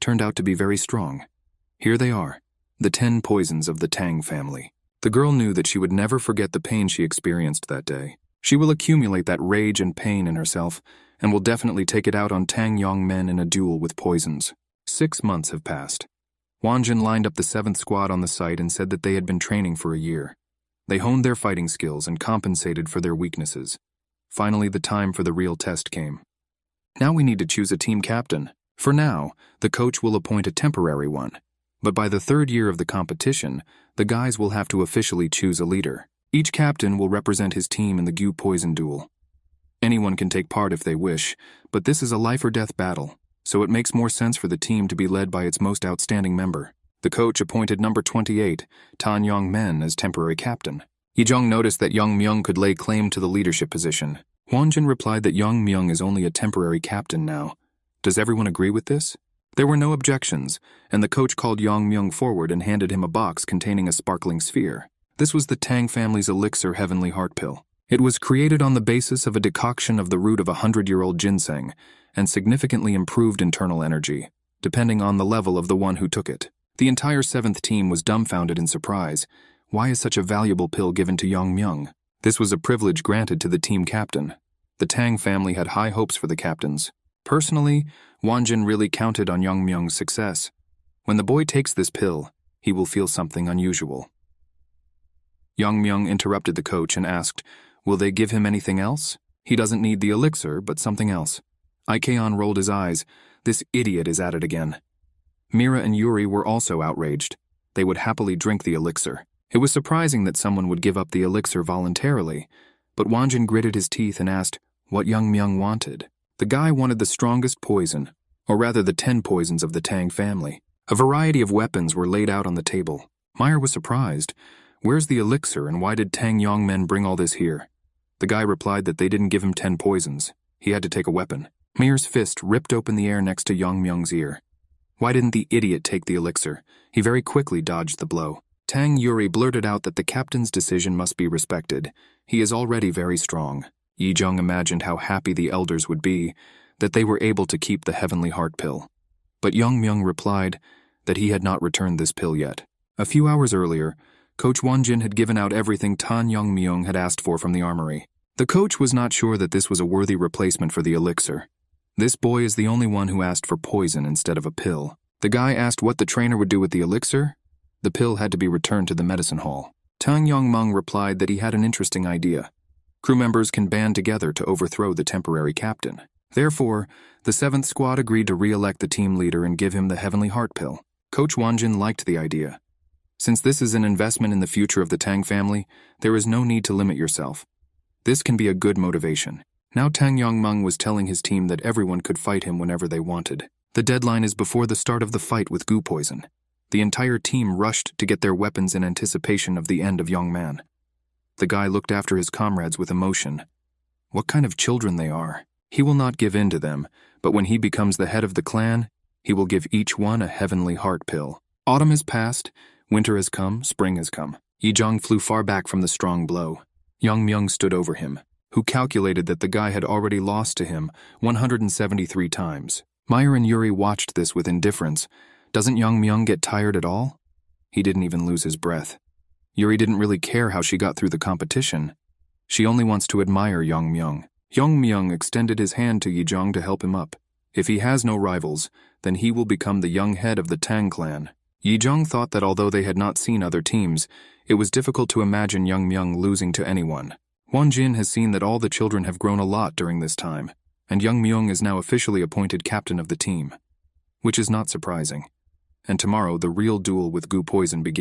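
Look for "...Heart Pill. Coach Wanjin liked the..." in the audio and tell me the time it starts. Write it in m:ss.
3:00.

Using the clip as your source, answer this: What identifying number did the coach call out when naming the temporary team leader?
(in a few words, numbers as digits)
28.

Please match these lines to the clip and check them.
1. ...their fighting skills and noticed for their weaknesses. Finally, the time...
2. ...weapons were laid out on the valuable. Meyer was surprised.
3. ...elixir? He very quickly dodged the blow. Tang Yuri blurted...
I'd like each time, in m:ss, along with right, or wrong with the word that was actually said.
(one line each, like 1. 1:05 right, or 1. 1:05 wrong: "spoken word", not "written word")
1. 0:21 wrong: "compensated", not "noticed"
2. 2:01 wrong: "table", not "valuable"
3. 2:16 right.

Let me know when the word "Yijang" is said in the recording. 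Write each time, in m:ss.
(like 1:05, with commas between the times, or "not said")
3:34.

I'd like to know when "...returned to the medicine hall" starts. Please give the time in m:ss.
2:48.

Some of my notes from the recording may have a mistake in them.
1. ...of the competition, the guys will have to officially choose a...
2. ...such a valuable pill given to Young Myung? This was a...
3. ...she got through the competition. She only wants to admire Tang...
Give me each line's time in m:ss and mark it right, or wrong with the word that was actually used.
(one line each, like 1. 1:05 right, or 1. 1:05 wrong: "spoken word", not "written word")
1. 0:32 right
2. 1:19 right
3. 3:50 wrong: "Yang", not "Tang".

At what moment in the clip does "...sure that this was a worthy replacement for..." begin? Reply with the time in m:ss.
2:39.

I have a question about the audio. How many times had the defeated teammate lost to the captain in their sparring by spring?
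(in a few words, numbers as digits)
173.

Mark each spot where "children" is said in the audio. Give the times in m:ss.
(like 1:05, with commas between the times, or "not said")
3:24, 4:08.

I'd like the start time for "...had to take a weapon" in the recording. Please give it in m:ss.
2:10.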